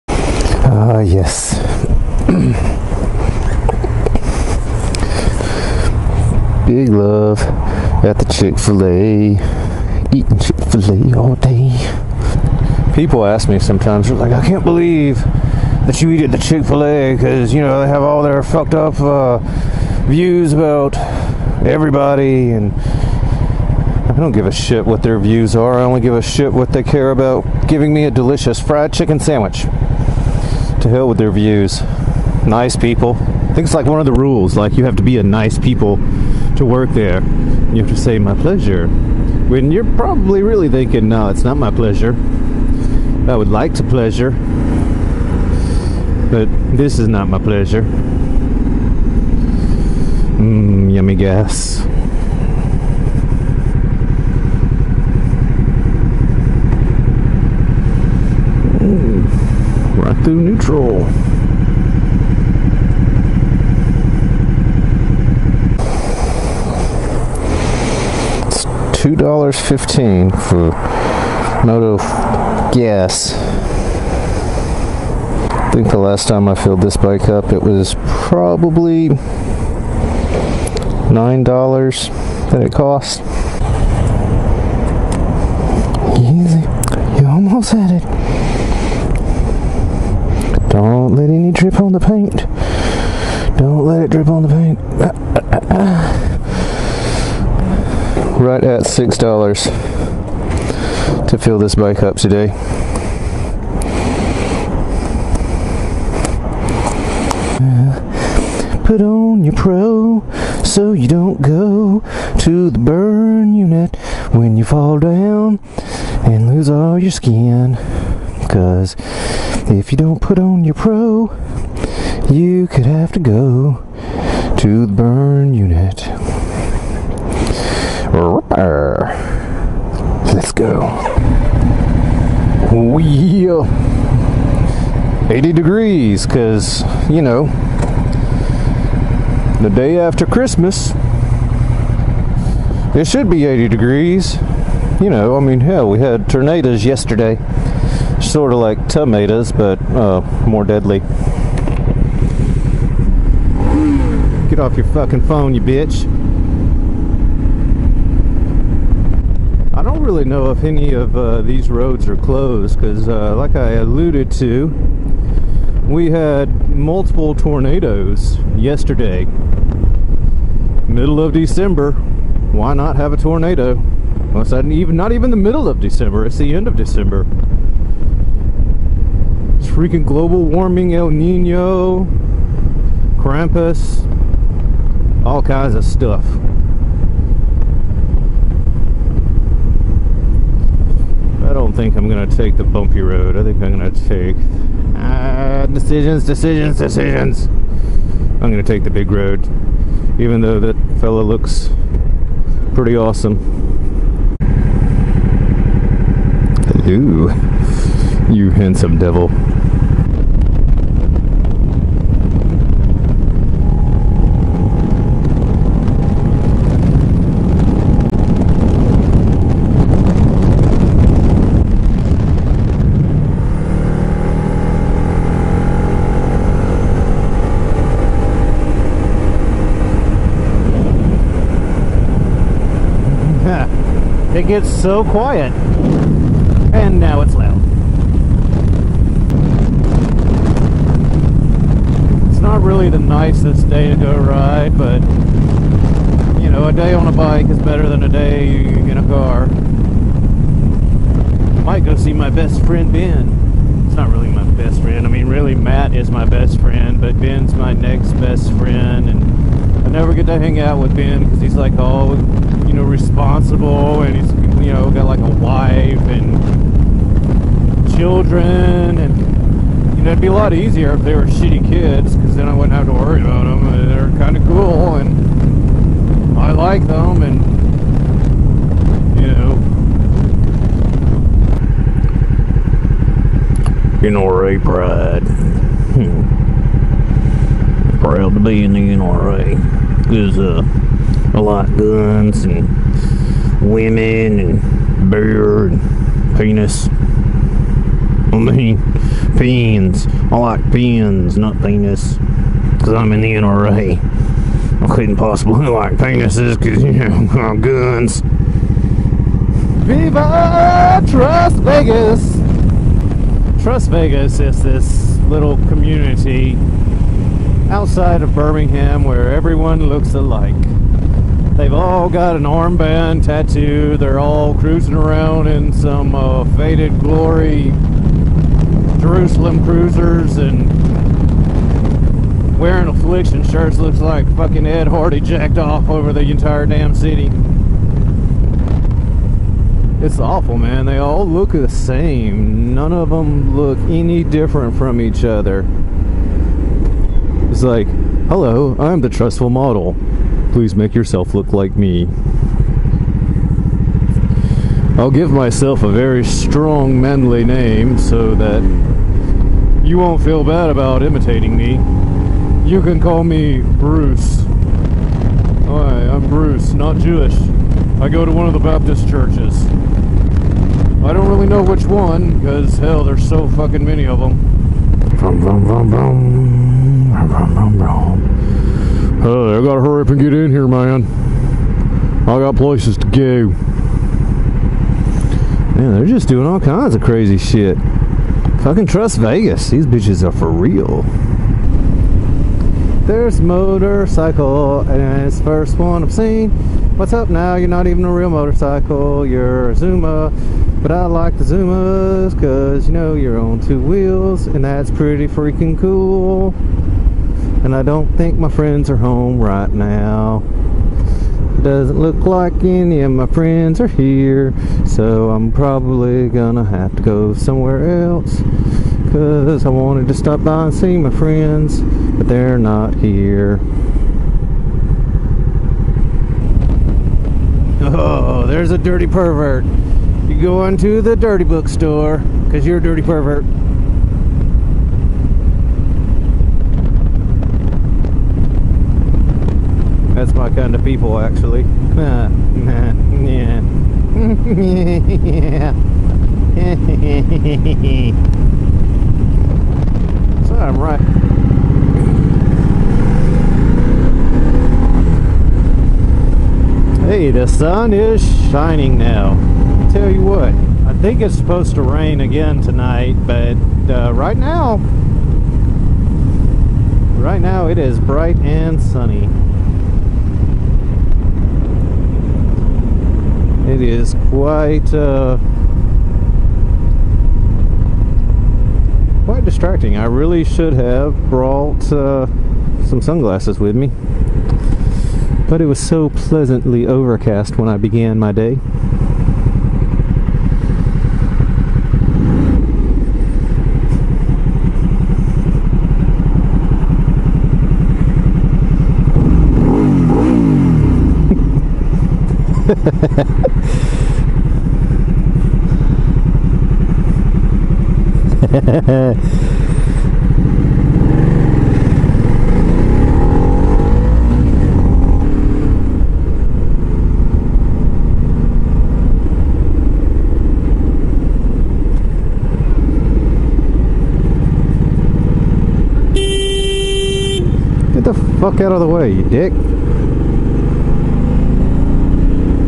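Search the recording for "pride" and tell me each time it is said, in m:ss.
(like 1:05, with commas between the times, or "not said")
4:44.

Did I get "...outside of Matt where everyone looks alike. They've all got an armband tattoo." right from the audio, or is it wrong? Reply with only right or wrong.
wrong.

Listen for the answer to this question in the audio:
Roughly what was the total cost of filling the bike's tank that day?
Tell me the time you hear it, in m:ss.
1:38.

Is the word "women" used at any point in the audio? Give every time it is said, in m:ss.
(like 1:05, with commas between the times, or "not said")
4:53.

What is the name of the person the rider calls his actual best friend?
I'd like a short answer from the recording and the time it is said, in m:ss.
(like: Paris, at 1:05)
Matt, at 4:15.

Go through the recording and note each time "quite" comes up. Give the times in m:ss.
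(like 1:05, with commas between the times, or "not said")
7:54, 7:59.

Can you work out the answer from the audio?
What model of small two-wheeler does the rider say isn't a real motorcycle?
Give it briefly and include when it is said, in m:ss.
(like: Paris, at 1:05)
Zuma, at 6:39.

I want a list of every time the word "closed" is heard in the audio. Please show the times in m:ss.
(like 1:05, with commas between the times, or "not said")
2:42.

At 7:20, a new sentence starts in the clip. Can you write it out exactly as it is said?
That's my kind of people, actually.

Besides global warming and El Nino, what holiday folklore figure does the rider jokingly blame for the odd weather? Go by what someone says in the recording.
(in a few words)
Krampus.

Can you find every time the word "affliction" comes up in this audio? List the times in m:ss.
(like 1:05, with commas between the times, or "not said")
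5:32.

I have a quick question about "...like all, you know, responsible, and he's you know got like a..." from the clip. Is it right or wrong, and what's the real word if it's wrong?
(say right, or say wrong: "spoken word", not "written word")
right.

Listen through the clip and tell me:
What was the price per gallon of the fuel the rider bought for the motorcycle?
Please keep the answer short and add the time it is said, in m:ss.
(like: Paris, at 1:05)
$2.15, at 1:09.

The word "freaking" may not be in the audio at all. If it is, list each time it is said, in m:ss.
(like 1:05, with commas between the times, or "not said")
2:59, 6:45.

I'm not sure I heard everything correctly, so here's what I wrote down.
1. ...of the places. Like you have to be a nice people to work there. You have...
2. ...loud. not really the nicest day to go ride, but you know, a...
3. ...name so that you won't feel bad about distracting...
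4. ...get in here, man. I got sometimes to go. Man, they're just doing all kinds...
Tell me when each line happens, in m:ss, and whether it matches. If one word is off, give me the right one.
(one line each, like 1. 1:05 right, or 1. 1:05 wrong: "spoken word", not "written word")
1. 0:33 wrong: "rules", not "places"
2. 3:57 right
3. 5:57 wrong: "imitating", not "distracting"
4. 6:20 wrong: "places", not "sometimes".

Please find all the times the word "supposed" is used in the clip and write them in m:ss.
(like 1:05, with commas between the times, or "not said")
7:41.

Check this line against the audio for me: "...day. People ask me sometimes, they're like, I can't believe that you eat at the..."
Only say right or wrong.
right.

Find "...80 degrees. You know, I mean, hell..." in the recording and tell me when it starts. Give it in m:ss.
2:23.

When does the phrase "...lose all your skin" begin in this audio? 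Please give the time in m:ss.
1:56.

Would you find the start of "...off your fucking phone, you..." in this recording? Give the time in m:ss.
2:34.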